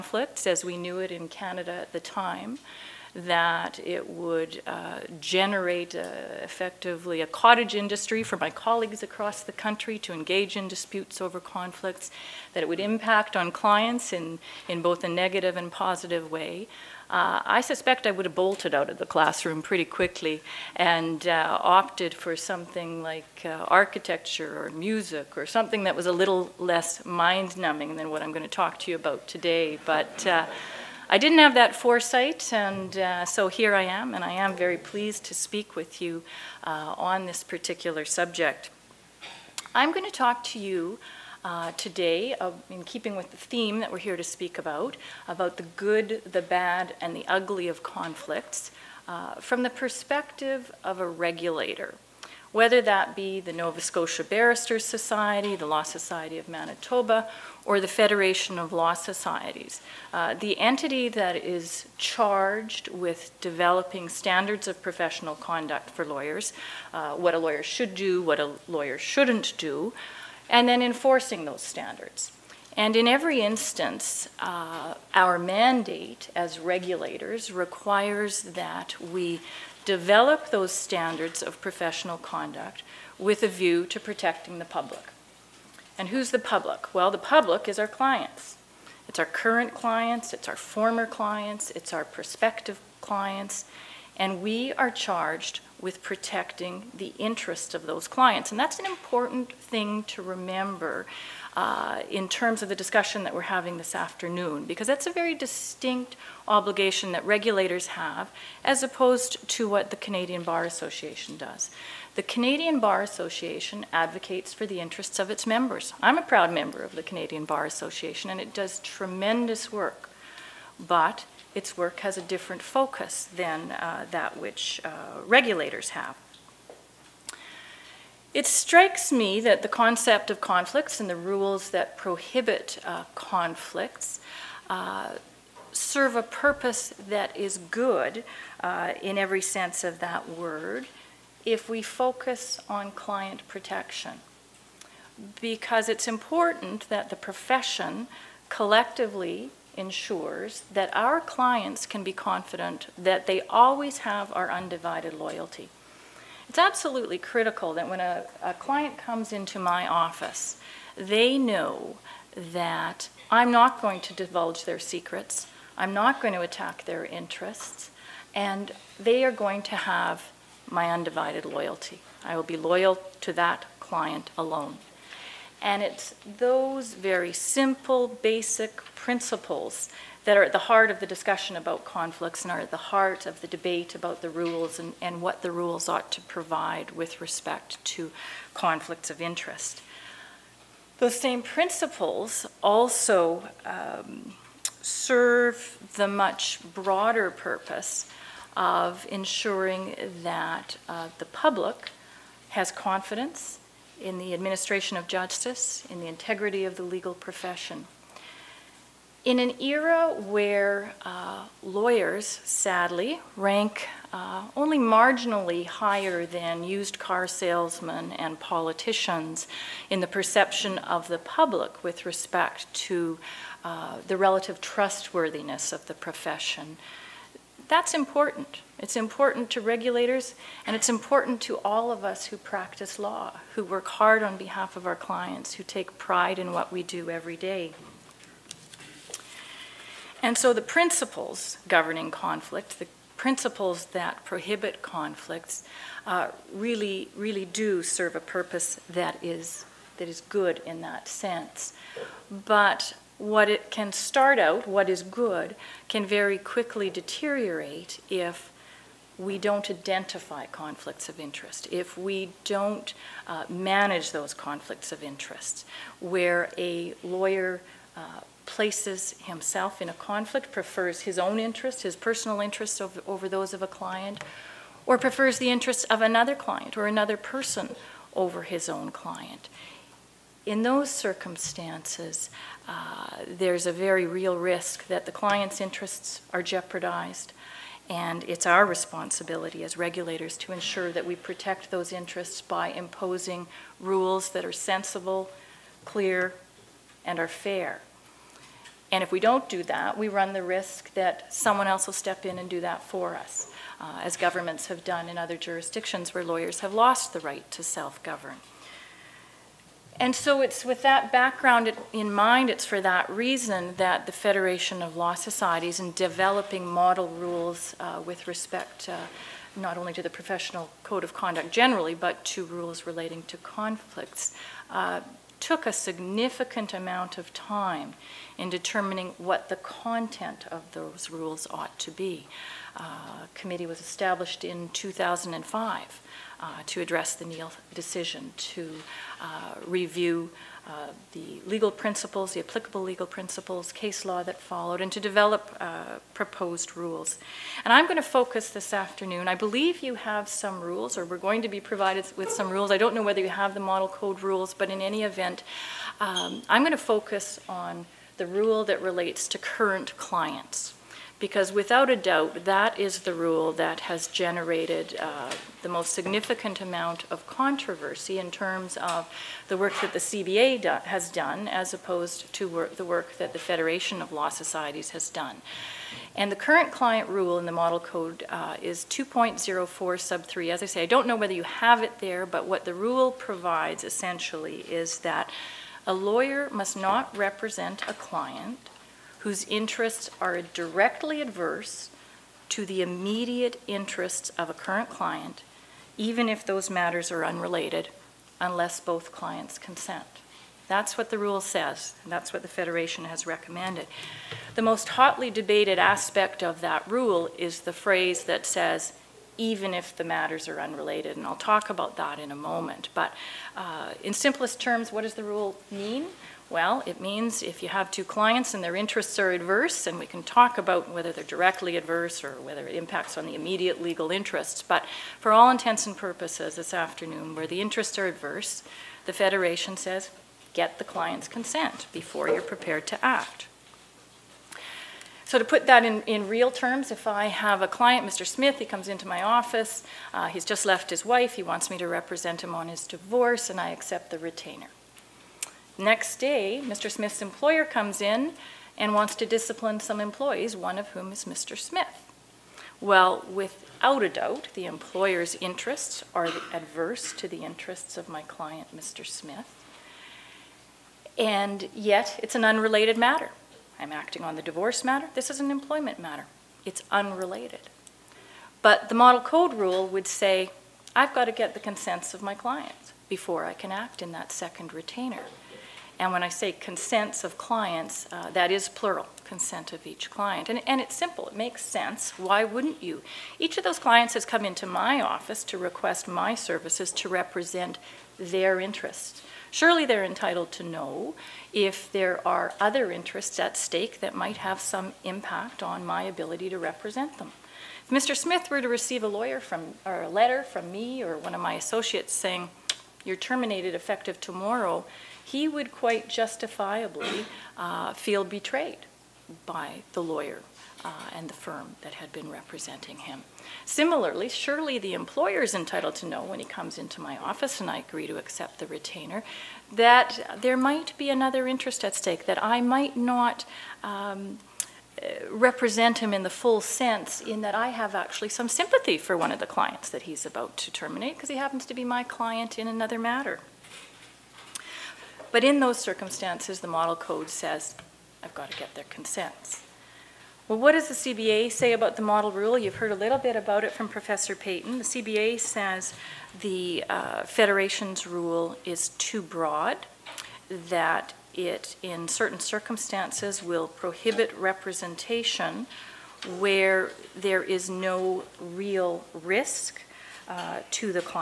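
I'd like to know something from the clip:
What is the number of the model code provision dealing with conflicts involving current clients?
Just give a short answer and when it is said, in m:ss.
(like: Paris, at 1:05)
2.04(3), at 6:18.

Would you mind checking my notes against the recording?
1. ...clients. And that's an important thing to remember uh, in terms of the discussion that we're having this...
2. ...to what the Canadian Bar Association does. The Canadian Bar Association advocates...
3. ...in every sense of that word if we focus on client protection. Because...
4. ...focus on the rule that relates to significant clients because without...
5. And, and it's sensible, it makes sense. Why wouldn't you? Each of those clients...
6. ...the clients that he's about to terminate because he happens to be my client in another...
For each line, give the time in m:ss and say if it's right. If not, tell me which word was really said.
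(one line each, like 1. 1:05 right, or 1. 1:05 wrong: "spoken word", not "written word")
1. 1:38 right
2. 1:49 right
3. 2:19 right
4. 5:56 wrong: "current", not "significant"
5. 8:00 wrong: "simple", not "sensible"
6. 8:49 right.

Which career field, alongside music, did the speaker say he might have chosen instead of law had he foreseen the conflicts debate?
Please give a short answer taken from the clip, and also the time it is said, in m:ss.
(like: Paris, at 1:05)
architecture, at 0:23.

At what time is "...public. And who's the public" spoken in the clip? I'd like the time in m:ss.
1:24.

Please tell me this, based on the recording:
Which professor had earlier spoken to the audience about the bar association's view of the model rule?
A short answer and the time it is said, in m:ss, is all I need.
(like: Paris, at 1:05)
Paton, at 9:04.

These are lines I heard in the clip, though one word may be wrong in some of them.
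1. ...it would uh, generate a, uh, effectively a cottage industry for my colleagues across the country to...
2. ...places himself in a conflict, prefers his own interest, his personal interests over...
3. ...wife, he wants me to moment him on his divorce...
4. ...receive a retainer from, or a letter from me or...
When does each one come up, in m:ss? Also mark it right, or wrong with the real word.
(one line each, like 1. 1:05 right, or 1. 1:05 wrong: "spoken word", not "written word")
1. 0:03 right
2. 4:28 right
3. 7:21 wrong: "represent", not "moment"
4. 8:18 wrong: "lawyer", not "retainer".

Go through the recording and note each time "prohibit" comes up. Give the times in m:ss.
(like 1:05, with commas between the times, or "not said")
2:11, 4:04, 9:13.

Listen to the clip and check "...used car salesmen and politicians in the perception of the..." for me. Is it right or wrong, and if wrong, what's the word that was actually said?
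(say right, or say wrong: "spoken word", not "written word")
right.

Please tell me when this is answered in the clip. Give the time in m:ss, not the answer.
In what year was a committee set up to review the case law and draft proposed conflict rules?
5:34.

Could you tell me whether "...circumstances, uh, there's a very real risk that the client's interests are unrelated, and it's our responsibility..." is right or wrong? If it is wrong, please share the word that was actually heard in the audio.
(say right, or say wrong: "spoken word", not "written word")
wrong: "jeopardized", not "unrelated".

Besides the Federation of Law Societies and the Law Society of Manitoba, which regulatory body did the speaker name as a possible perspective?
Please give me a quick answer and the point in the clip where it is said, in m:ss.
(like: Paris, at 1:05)
Nova Scotia Barristers Society, at 0:53.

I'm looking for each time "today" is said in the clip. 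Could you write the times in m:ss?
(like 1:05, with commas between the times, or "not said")
0:29, 0:41.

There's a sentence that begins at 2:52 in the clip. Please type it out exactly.
I will be loyal to that client alone.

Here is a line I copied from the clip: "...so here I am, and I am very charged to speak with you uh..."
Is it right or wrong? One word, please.
wrong.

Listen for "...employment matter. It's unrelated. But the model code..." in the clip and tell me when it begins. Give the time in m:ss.
7:45.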